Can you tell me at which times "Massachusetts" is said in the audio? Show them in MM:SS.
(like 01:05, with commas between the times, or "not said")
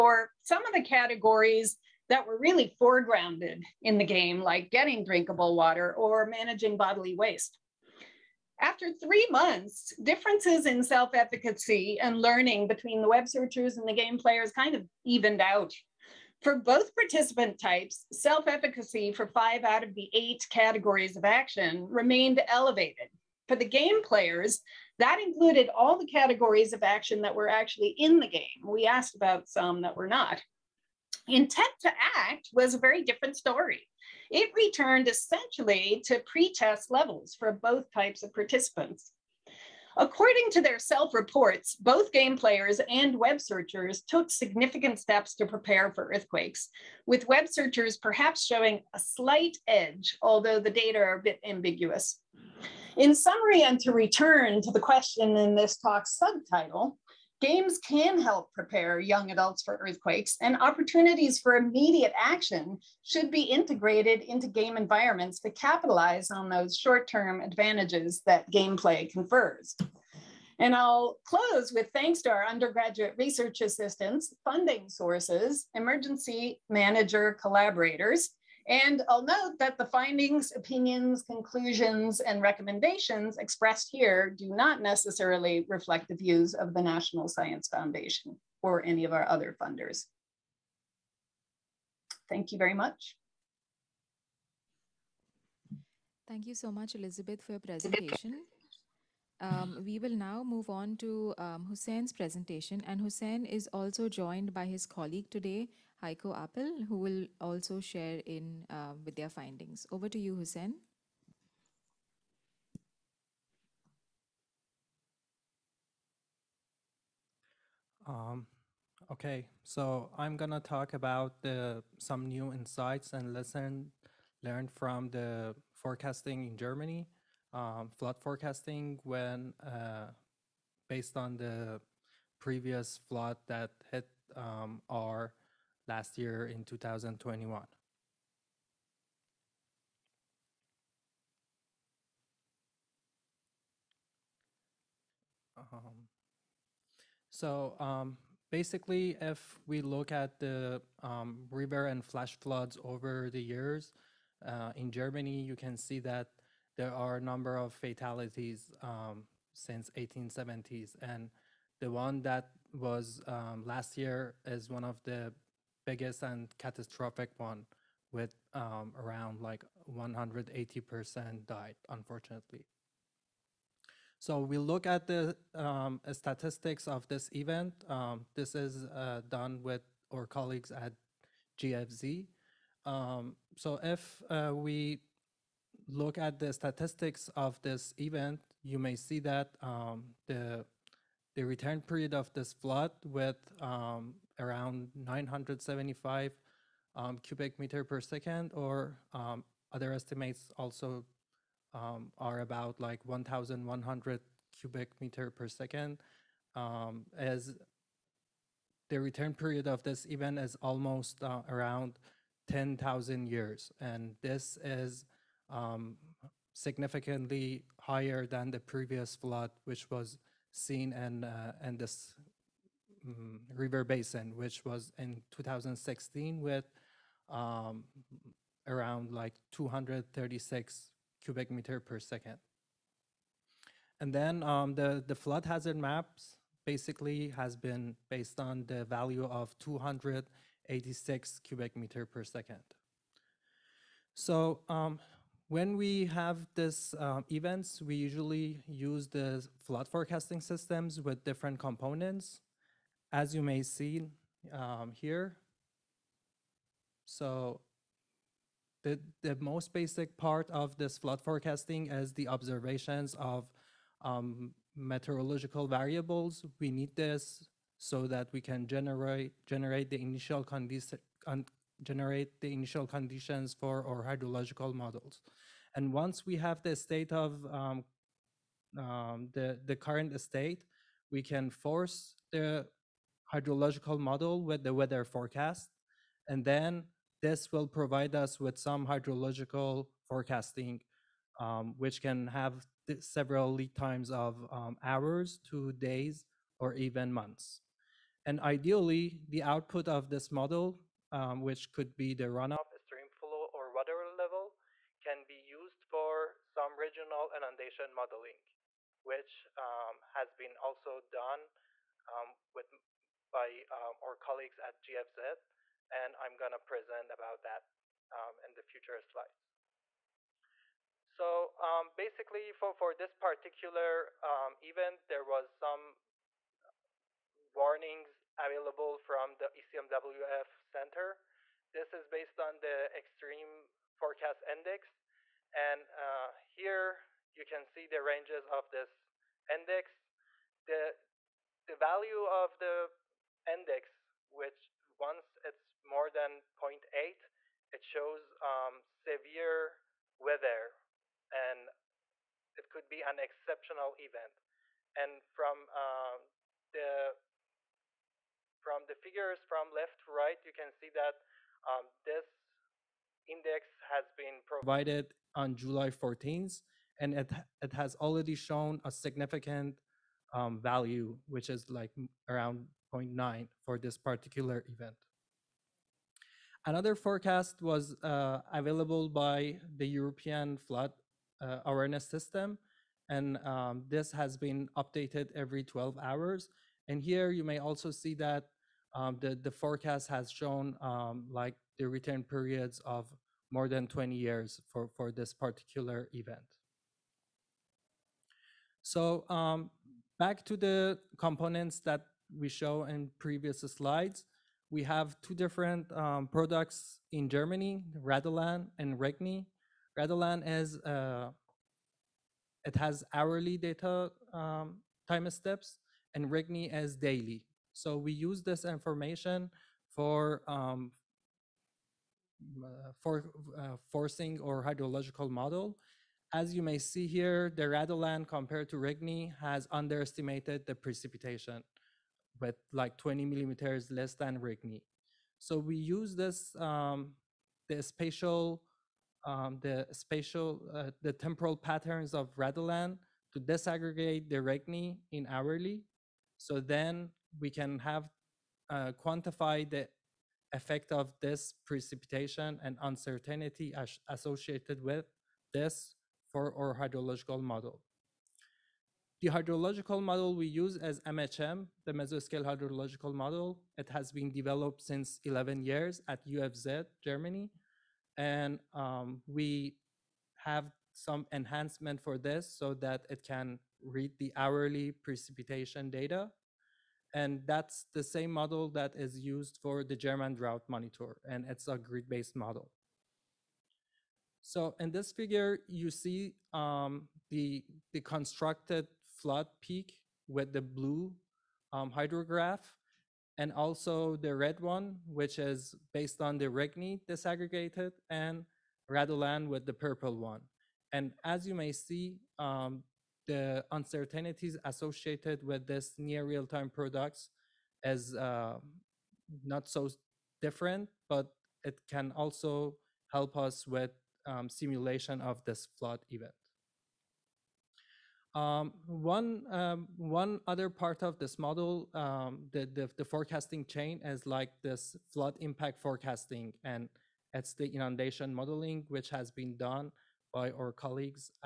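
not said.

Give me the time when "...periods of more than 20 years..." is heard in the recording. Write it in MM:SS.
06:32.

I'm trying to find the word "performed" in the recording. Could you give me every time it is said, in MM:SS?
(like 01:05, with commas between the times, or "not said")
not said.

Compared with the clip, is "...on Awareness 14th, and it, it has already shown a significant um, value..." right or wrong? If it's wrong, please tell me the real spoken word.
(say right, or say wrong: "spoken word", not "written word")
wrong: "July", not "Awareness".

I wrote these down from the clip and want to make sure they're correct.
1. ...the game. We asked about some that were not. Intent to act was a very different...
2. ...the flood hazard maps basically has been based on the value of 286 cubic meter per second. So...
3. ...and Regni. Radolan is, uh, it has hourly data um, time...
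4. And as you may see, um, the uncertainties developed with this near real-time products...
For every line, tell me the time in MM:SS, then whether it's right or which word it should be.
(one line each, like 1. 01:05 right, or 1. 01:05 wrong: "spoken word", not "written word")
1. 00:28 right
2. 03:55 right
3. 06:48 right
4. 08:20 wrong: "associated", not "developed".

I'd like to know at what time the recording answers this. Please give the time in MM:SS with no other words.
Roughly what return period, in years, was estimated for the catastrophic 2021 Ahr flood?
03:32.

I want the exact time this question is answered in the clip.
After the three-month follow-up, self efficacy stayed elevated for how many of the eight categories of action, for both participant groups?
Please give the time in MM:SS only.
00:19.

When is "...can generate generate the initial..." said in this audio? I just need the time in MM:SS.
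04:28.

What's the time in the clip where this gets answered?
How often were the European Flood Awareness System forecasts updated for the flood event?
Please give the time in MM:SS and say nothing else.
06:25.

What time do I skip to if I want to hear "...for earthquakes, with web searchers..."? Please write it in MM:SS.
00:45.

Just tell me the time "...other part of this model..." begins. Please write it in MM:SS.
08:40.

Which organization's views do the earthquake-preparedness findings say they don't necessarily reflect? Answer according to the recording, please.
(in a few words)
National Science Foundation.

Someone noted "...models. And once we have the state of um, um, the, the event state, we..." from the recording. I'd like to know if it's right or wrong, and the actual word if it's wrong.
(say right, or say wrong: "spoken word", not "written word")
wrong: "current", not "event".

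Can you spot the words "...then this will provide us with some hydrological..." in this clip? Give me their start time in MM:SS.
04:46.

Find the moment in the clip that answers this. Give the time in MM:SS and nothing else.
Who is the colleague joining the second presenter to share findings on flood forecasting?
01:46.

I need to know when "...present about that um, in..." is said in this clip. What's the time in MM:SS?
05:16.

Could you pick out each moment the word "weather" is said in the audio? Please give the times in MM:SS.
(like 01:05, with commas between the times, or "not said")
04:44, 05:50.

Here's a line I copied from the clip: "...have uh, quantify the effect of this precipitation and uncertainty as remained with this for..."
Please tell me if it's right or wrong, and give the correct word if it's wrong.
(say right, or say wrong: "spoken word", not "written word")
wrong: "associated", not "remained".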